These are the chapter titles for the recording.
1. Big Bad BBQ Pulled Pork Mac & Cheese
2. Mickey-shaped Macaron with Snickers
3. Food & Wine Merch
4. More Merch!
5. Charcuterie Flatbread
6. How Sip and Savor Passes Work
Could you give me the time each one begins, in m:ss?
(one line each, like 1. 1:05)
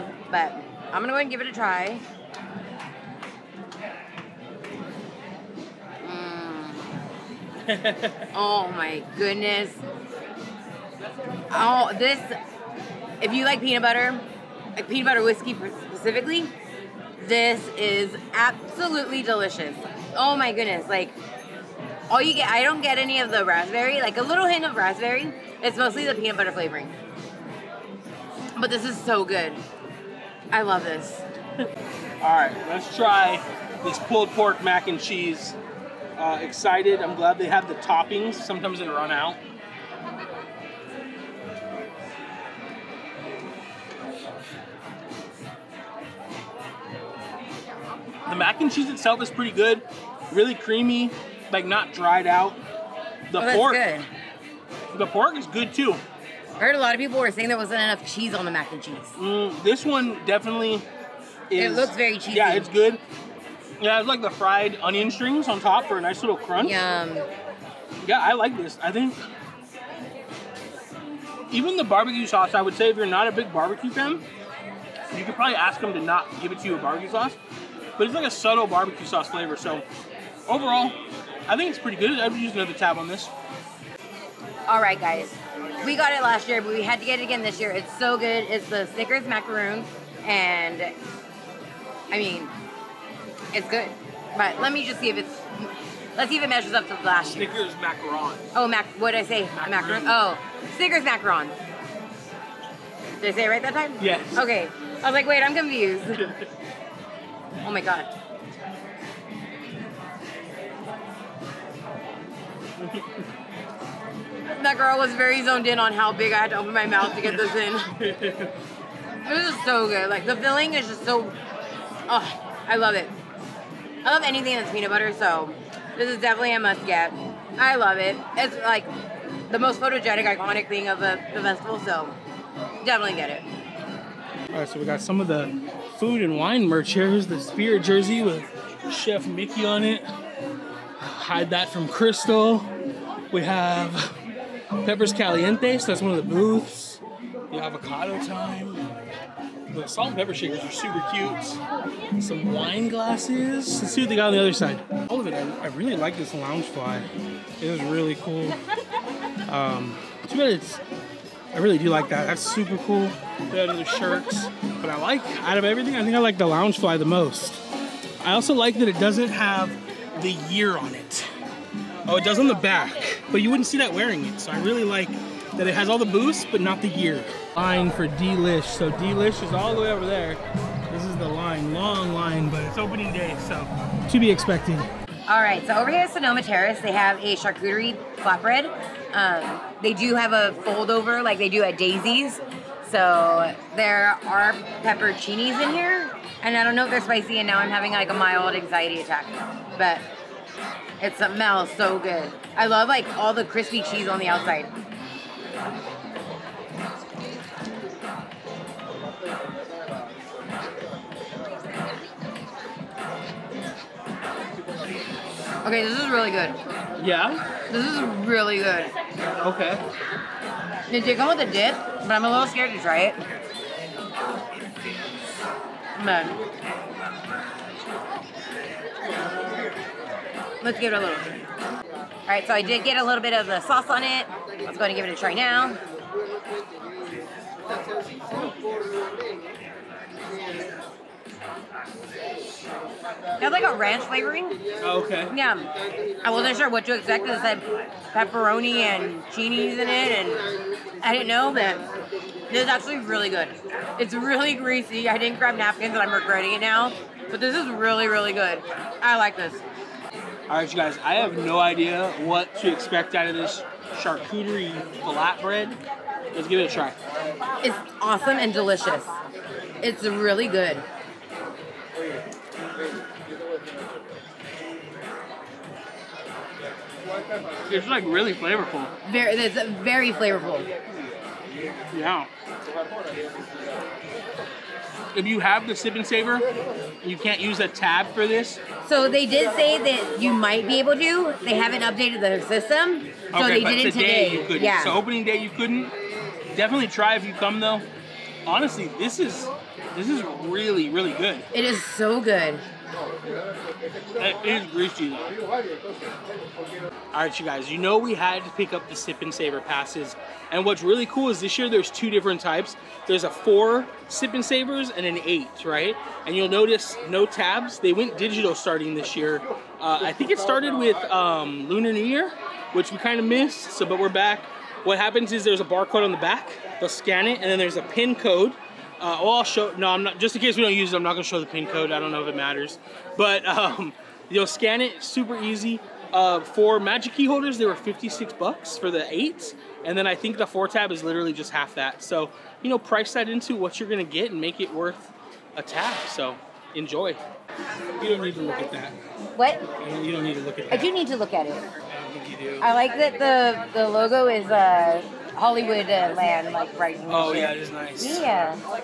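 1. 0:31
2. 1:23
3. 2:13
4. 5:46
5. 3:04
6. 5:05.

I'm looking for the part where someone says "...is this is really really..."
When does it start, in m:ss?
4:59.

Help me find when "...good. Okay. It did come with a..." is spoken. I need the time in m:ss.
3:38.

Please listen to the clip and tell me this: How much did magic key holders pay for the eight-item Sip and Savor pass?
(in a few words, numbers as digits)
$56.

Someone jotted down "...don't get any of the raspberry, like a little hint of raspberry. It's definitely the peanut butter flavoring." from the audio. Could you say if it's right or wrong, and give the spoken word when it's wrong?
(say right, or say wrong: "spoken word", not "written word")
wrong: "mostly", not "definitely".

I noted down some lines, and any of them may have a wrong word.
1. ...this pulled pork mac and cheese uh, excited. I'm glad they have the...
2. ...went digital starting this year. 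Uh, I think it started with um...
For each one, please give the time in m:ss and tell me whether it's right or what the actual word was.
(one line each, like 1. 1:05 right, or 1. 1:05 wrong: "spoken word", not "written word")
1. 0:33 right
2. 5:17 right.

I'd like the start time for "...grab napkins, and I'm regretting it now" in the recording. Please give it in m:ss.
4:15.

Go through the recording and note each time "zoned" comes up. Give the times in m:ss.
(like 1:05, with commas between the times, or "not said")
1:55.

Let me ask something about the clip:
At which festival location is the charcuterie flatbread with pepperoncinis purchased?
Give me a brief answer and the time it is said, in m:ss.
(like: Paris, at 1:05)
Sonoma Terrace, at 3:06.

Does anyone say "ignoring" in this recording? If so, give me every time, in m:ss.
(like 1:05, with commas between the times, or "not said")
not said.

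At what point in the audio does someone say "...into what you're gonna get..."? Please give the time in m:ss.
5:43.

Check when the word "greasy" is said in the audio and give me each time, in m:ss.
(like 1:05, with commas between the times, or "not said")
4:14, 5:04.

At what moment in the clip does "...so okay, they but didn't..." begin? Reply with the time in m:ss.
4:53.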